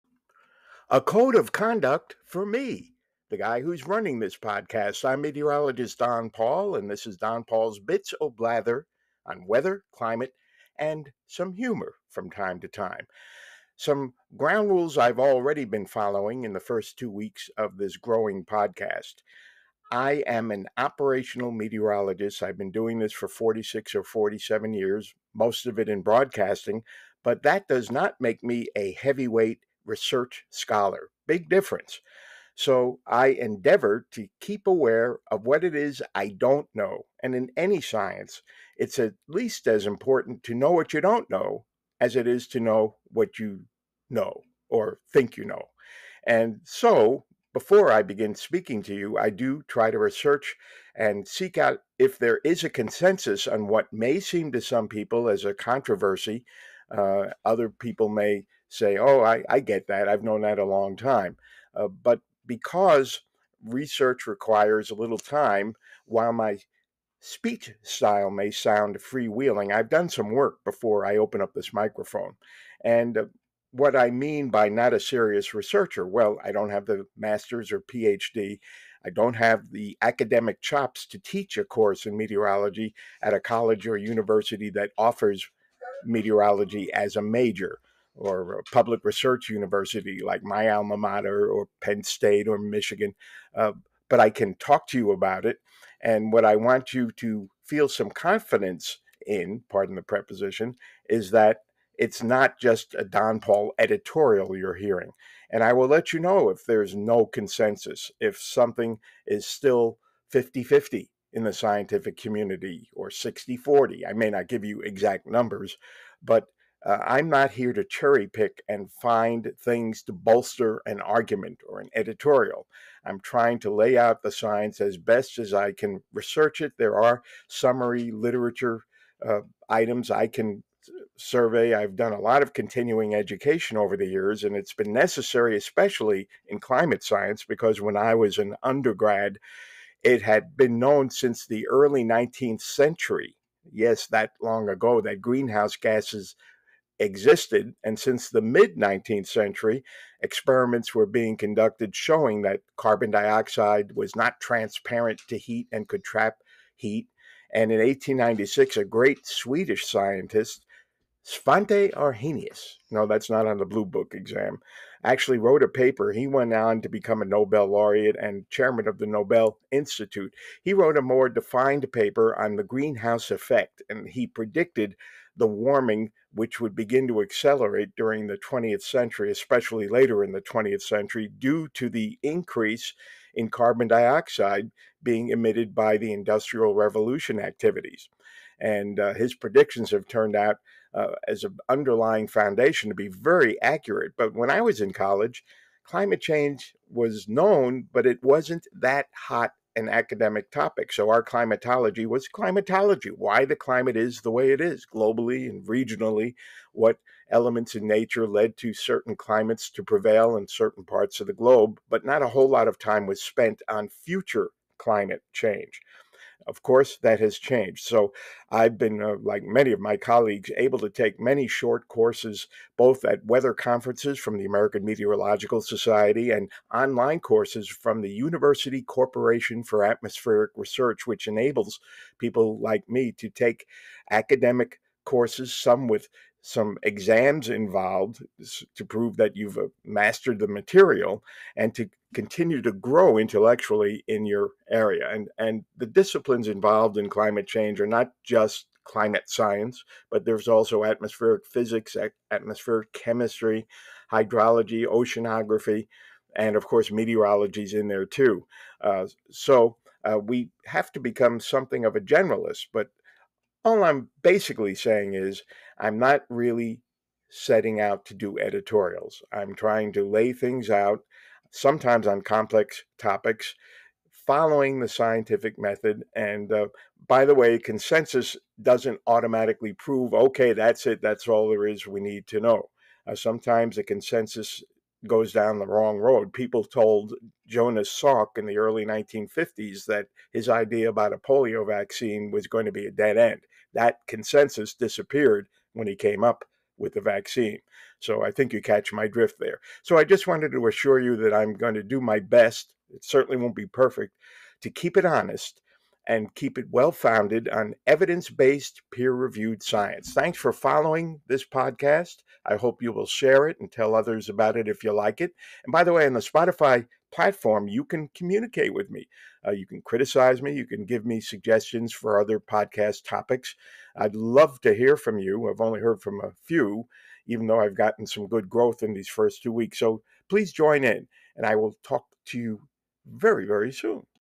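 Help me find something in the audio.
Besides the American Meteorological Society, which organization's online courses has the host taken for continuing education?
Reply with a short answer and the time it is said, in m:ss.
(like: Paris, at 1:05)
University Corporation for Atmospheric Research, at 3:48.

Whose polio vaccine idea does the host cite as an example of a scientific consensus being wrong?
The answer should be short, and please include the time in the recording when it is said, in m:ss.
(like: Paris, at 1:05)
Jonas Salk, at 4:47.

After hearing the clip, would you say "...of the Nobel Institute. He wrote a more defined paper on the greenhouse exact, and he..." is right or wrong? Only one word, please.
wrong.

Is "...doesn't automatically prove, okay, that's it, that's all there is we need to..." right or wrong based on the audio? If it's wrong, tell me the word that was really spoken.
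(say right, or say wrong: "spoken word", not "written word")
right.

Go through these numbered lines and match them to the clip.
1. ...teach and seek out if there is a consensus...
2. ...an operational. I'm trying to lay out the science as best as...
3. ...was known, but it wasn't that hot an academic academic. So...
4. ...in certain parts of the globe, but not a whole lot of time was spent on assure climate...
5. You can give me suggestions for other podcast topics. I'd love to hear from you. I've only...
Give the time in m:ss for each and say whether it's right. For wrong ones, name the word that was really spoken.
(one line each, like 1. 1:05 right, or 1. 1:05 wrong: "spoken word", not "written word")
1. 0:49 wrong: "research", not "teach"
2. 2:01 wrong: "editorial", not "operational"
3. 3:16 wrong: "topic", not "academic"
4. 3:30 wrong: "future", not "assure"
5. 5:20 right.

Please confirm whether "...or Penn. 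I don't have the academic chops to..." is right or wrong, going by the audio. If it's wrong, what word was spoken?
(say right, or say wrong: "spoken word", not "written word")
wrong: "PhD", not "Penn".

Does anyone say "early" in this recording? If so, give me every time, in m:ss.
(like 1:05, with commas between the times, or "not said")
2:21, 4:48.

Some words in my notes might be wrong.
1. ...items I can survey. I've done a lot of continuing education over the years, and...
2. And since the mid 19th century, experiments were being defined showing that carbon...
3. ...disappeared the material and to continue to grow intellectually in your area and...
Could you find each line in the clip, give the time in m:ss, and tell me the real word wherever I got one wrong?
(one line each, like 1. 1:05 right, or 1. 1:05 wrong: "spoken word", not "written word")
1. 2:09 right
2. 2:27 wrong: "conducted", not "defined"
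3. 3:59 wrong: "mastered", not "disappeared".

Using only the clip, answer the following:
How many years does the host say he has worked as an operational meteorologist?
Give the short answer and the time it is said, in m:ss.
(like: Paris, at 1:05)
46 or 47, at 0:23.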